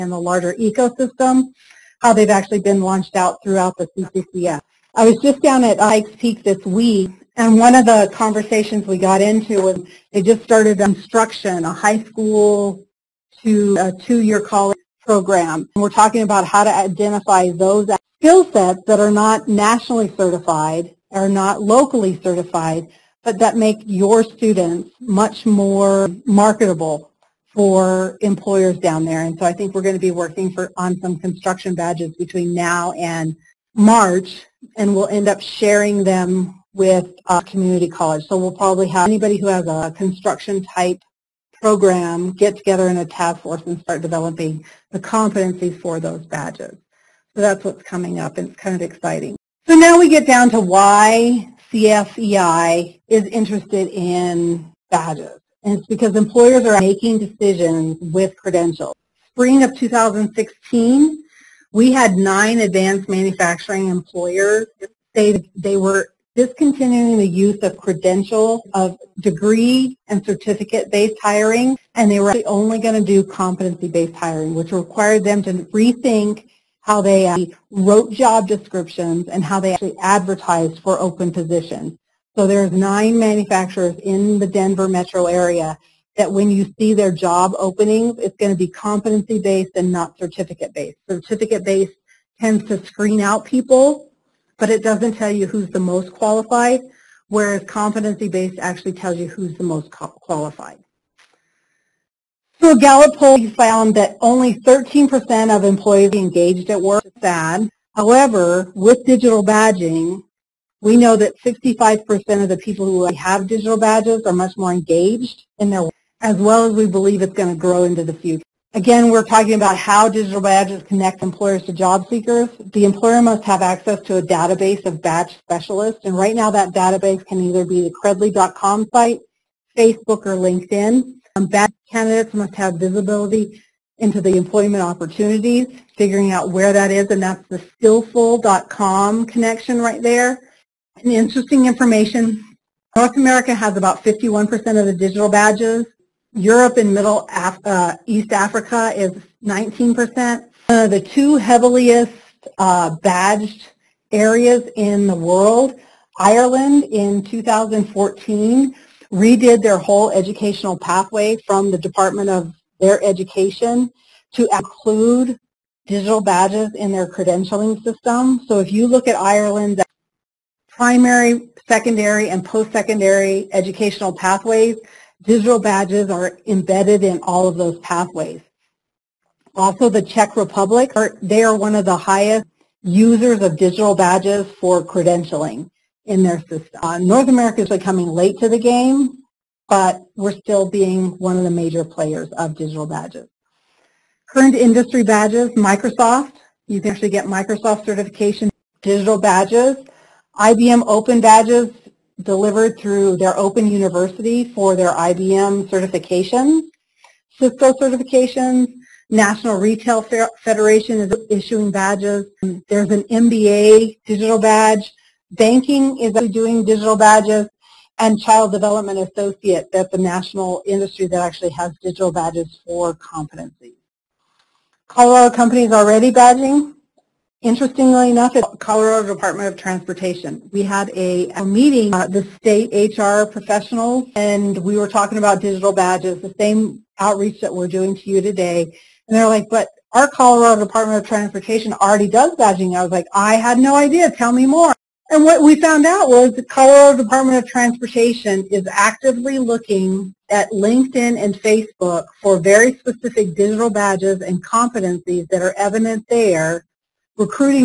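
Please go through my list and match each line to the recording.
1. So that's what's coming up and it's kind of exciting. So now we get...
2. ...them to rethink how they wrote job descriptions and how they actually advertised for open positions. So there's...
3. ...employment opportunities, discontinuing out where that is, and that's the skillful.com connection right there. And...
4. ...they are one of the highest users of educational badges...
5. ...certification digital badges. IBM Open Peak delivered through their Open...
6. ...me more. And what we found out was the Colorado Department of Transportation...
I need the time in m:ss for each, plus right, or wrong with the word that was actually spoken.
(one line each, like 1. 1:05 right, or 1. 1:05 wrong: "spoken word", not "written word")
1. 0:47 right
2. 1:15 right
3. 2:14 wrong: "figuring", not "discontinuing"
4. 3:01 wrong: "digital", not "educational"
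5. 3:17 wrong: "Badges", not "Peak"
6. 4:04 right.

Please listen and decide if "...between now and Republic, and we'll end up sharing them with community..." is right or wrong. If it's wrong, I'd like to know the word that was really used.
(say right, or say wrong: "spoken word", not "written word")
wrong: "March", not "Republic".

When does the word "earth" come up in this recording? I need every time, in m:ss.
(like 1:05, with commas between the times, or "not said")
not said.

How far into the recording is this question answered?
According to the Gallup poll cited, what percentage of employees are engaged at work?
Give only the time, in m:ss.
1:44.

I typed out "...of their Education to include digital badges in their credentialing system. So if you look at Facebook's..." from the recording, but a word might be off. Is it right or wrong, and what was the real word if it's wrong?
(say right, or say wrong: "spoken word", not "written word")
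wrong: "Ireland", not "Facebook".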